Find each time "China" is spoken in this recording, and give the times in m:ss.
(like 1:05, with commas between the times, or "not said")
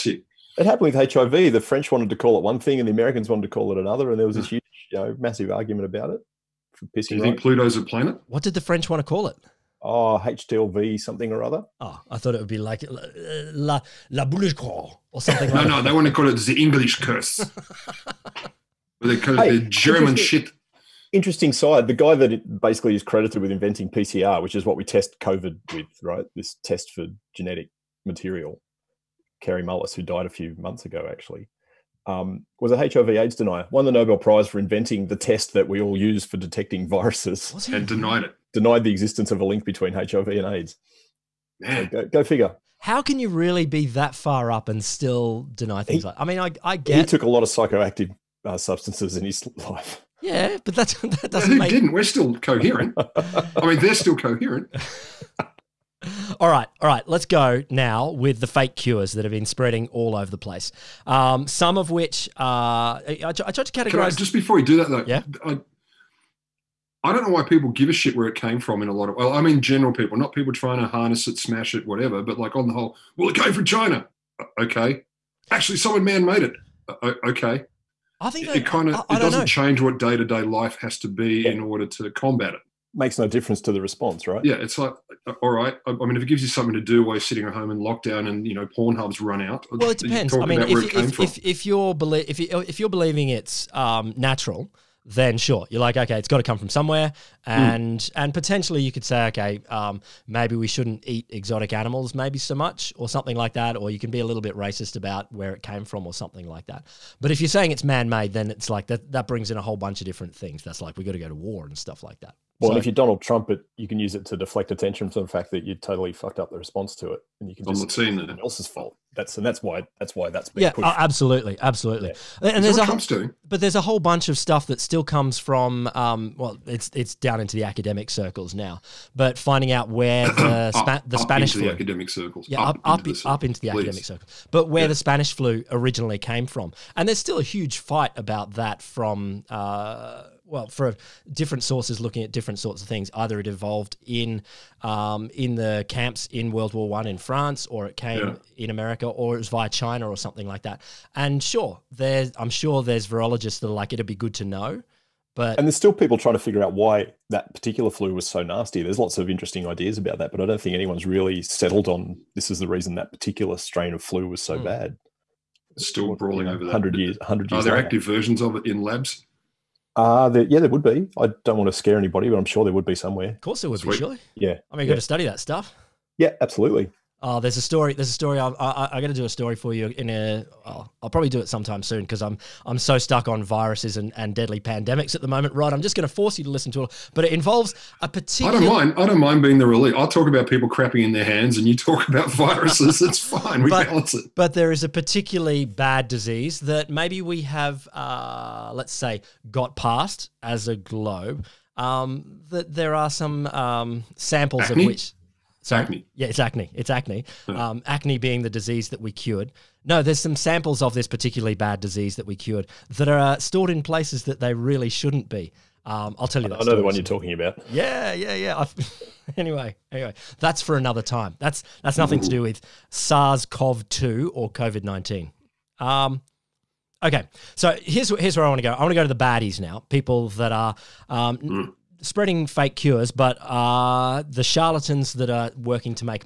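1:13, 2:29.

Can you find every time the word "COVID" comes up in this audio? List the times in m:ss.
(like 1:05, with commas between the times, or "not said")
0:25, 3:44.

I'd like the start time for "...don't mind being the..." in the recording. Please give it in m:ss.
3:09.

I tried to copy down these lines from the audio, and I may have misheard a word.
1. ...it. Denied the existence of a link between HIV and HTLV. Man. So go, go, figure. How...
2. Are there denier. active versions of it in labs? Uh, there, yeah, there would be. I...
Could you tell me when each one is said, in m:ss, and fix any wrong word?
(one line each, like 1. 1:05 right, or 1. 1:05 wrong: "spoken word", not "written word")
1. 0:38 wrong: "AIDS", not "HTLV"
2. 2:47 wrong: "later", not "denier".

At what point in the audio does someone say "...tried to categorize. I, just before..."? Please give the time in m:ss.
1:03.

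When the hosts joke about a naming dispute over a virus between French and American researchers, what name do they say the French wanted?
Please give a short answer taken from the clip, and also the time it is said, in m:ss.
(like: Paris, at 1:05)
HTLV, at 0:10.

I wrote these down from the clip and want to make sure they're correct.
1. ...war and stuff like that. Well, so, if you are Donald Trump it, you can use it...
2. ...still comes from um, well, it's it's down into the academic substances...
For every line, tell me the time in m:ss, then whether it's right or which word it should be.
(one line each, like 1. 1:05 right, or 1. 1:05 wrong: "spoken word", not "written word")
1. 1:51 right
2. 2:04 wrong: "circles", not "substances".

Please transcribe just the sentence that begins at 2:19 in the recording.
Uh, well for different sources looking at different sorts of things.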